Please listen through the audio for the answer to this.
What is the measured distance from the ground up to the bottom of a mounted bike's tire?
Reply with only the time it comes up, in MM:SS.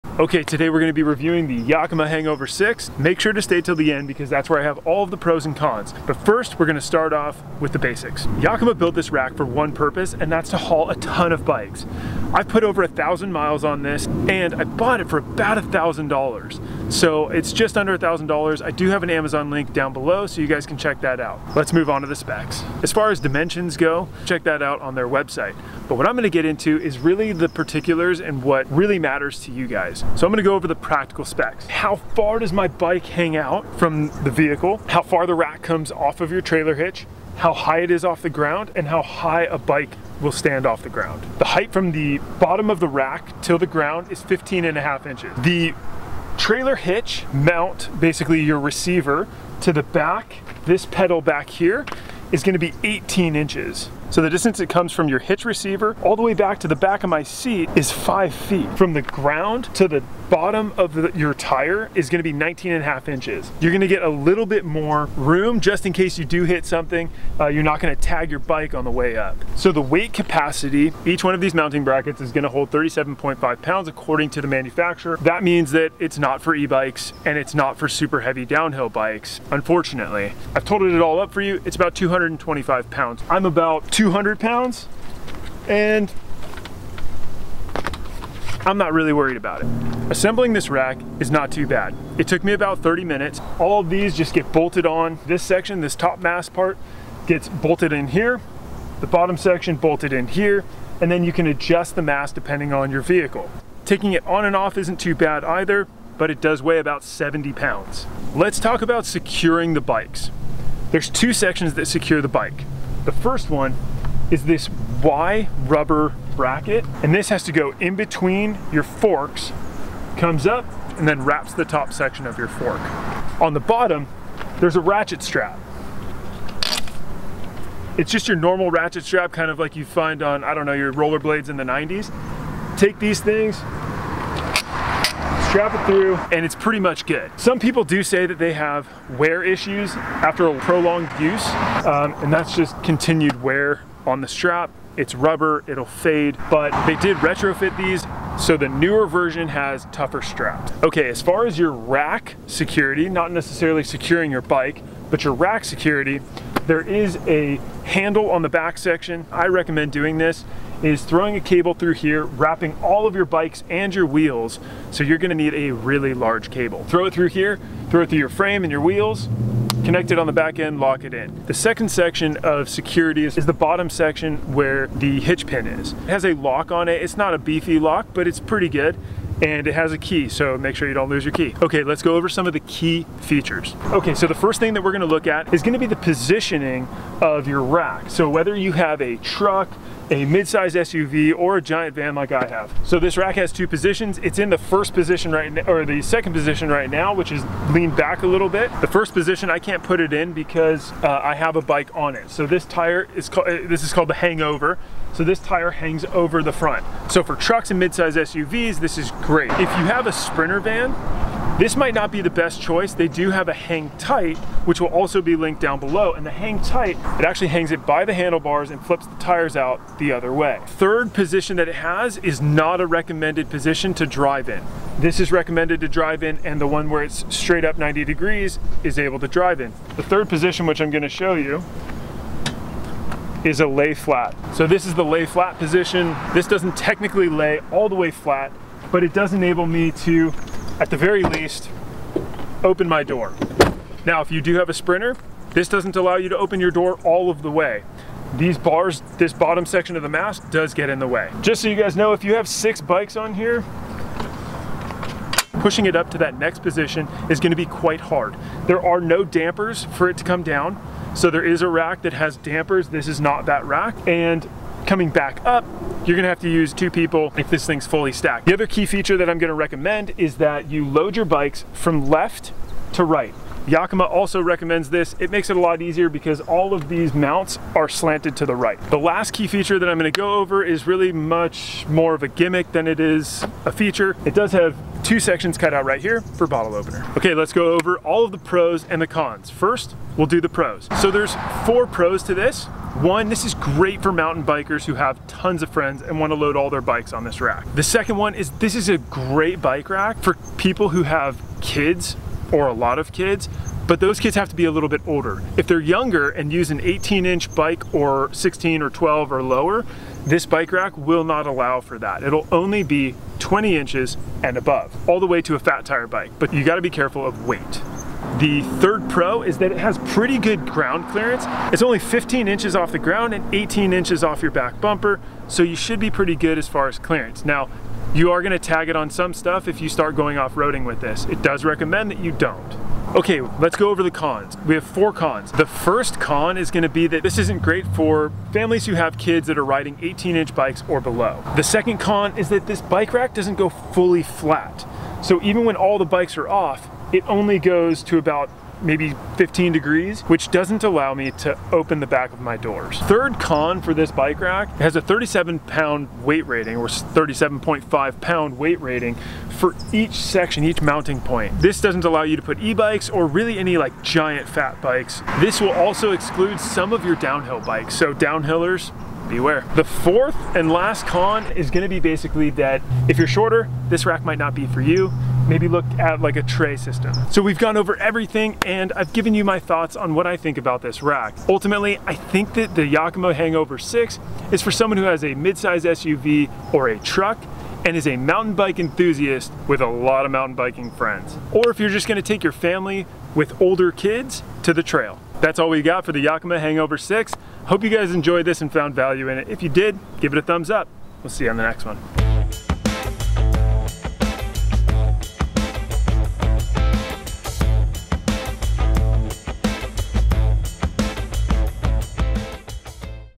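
01:02.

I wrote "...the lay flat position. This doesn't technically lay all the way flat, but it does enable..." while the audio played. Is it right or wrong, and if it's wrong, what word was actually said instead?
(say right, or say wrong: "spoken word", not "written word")
right.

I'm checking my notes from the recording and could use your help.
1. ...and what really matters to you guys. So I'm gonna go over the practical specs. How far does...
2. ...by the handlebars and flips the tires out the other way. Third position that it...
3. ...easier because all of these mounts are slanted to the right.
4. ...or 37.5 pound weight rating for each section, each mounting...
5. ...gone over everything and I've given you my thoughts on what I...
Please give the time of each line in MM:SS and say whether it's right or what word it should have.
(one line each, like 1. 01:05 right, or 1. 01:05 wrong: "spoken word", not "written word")
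1. 00:28 right
2. 03:37 right
3. 04:35 right
4. 05:56 right
5. 06:17 right.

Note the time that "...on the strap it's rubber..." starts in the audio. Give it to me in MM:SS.
02:24.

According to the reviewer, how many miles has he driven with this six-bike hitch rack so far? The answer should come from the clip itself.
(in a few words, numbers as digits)
Over 1,000 miles.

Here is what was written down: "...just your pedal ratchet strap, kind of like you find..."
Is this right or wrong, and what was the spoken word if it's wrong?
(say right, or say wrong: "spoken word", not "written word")
wrong: "normal", not "pedal".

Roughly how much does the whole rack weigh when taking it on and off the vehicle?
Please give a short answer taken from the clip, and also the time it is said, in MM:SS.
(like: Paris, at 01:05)
About 70 pounds, at 01:46.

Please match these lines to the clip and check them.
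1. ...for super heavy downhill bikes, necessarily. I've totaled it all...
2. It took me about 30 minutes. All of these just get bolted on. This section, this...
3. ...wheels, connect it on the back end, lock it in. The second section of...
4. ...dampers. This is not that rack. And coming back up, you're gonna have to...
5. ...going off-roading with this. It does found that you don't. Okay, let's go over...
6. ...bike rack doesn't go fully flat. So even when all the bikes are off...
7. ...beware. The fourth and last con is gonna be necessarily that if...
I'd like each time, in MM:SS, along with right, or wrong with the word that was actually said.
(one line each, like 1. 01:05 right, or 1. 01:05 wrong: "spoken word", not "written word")
1. 01:17 wrong: "unfortunately", not "necessarily"
2. 01:32 right
3. 02:48 right
4. 04:22 right
5. 05:30 wrong: "recommend", not "found"
6. 05:42 right
7. 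06:09 wrong: "basically", not "necessarily".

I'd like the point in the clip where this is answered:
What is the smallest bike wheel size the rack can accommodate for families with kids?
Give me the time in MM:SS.
05:13.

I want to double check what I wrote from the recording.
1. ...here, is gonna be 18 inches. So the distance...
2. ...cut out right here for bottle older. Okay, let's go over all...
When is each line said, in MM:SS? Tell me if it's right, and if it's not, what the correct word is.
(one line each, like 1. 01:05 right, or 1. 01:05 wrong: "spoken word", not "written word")
1. 00:51 right
2. 04:45 wrong: "opener", not "older".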